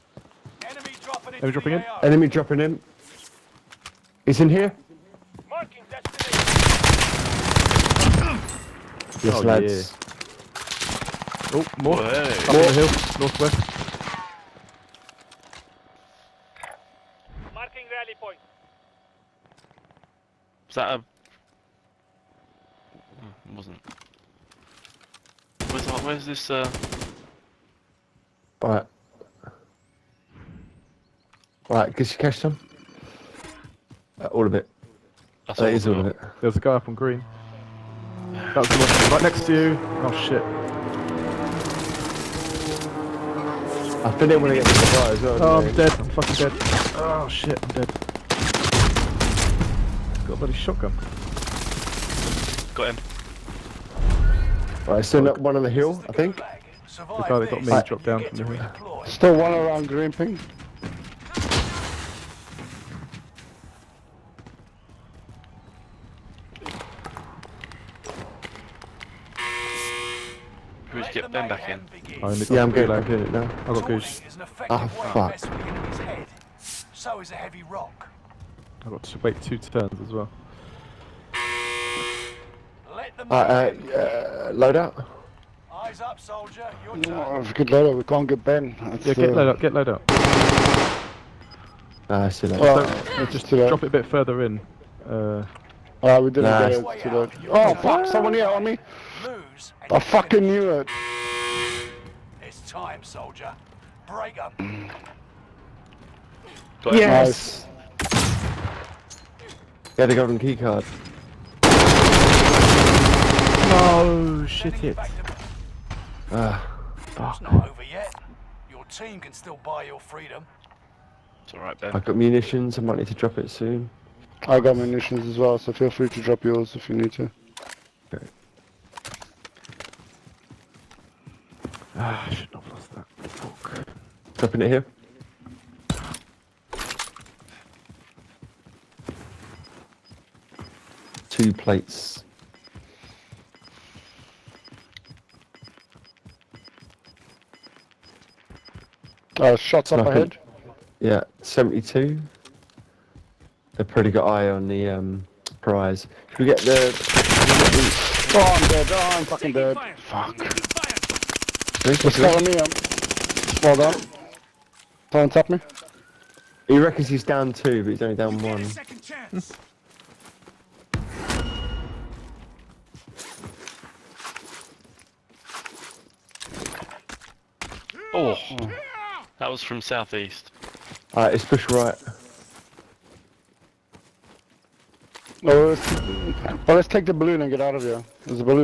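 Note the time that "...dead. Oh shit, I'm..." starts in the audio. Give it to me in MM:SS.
00:46.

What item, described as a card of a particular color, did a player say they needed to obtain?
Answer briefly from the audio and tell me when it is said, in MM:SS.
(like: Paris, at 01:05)
golden key card, at 01:49.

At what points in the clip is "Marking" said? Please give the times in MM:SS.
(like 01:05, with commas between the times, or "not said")
00:05, 00:17.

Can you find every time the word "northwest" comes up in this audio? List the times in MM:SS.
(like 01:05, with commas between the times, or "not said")
00:13.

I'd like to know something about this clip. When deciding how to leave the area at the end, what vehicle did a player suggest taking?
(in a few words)
balloon.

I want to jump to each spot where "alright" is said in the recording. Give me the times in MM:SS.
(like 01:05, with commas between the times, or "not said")
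02:01, 03:01.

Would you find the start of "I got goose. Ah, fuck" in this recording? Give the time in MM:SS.
01:13.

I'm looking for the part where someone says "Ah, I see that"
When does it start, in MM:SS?
01:30.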